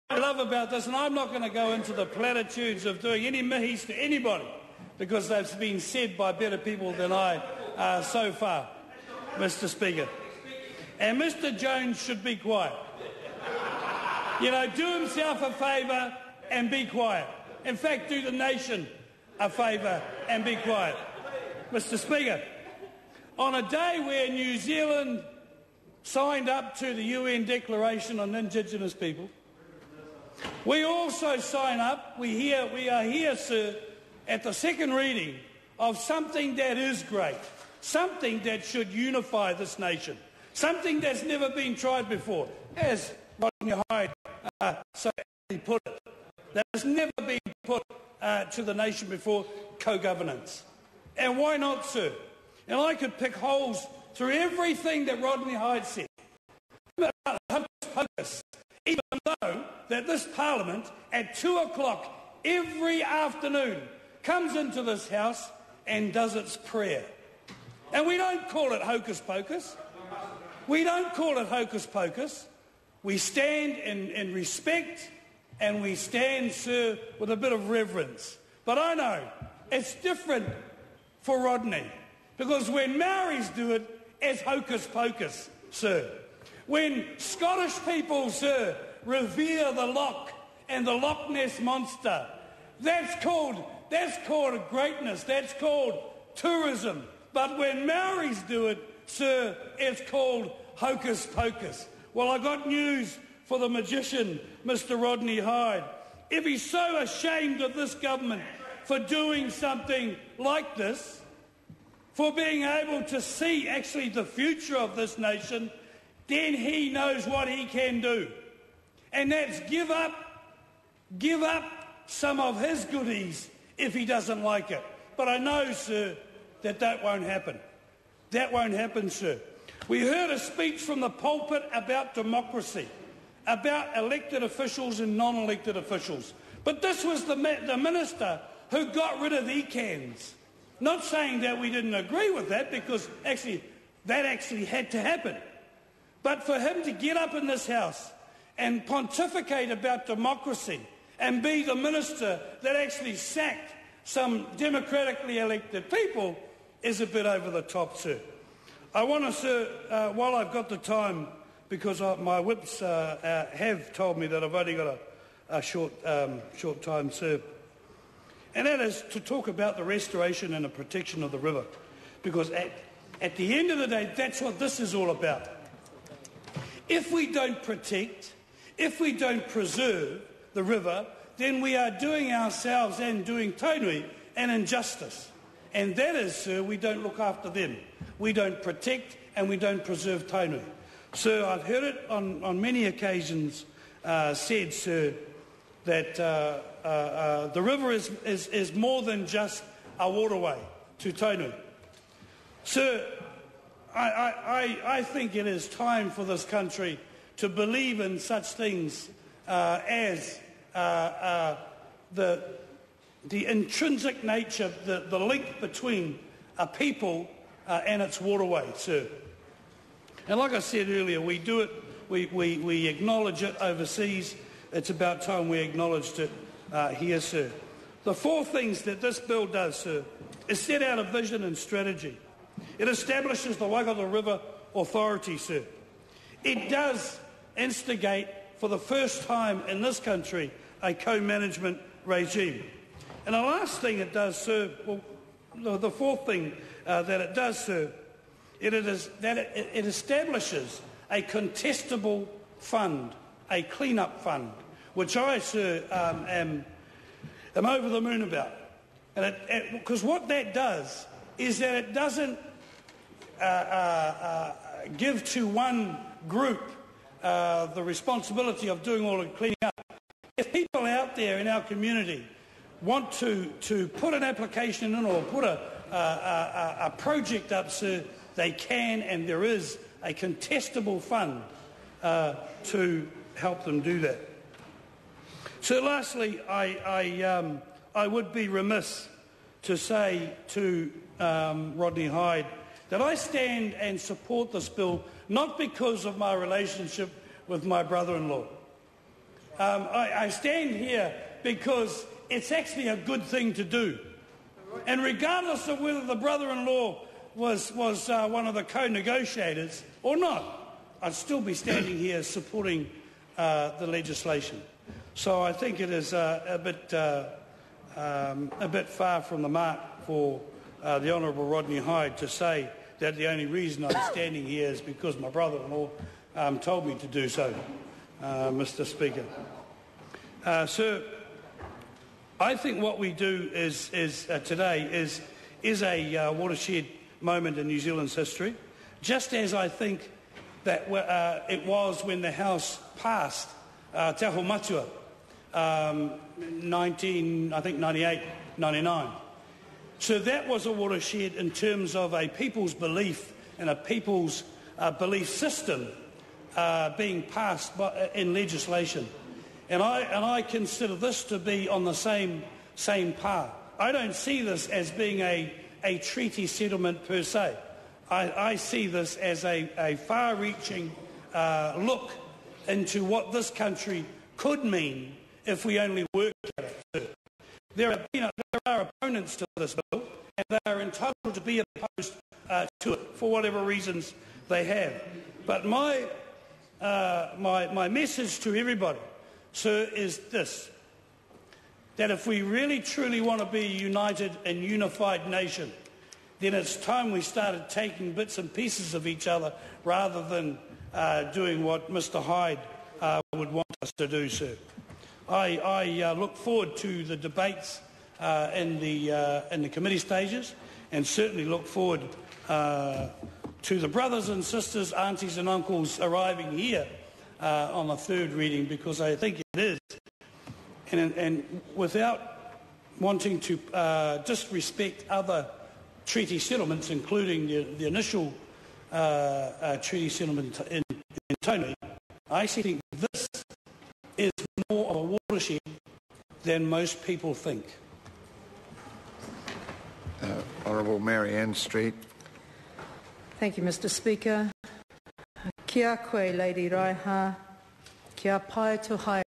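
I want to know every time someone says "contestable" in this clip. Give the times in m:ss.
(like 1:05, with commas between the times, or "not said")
4:11, 4:40.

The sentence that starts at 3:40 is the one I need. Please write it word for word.
And like I said earlier, we do it, we, we, we acknowledge it overseas.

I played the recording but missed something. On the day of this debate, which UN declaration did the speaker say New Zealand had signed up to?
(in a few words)
UN Declaration on Indigenous People.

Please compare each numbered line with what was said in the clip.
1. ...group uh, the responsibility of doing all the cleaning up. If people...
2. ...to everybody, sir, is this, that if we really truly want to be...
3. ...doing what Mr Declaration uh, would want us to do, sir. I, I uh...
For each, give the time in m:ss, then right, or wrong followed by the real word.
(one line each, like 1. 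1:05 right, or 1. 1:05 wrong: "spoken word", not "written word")
1. 4:26 right
2. 6:28 right
3. 6:41 wrong: "Hide", not "Declaration".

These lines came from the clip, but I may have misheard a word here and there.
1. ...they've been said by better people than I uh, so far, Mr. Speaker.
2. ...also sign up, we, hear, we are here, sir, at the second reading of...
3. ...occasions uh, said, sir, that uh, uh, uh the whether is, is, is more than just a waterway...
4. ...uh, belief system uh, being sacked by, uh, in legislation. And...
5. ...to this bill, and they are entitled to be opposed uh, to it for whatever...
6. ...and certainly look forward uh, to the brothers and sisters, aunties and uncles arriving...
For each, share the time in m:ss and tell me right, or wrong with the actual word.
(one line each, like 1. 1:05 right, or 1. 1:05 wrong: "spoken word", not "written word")
1. 0:05 right
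2. 0:30 right
3. 3:12 wrong: "river", not "whether"
4. 5:54 wrong: "passed", not "sacked"
5. 6:19 right
6. 6:50 right.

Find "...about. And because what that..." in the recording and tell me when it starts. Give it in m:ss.
4:18.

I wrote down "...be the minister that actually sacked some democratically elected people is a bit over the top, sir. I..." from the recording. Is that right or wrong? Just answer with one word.
right.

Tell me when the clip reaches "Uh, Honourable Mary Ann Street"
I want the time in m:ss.
7:20.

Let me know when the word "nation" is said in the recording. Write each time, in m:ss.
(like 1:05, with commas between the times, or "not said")
0:18, 0:39, 0:48, 1:55, 6:35.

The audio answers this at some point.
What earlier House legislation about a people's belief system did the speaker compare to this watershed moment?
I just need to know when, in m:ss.
5:44.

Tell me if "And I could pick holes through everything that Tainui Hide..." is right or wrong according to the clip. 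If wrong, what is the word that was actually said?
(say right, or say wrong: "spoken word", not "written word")
wrong: "Rodney", not "Tainui".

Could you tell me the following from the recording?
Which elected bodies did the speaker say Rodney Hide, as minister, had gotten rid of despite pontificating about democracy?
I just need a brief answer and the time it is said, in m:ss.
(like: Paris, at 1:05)
ECANs, at 2:19.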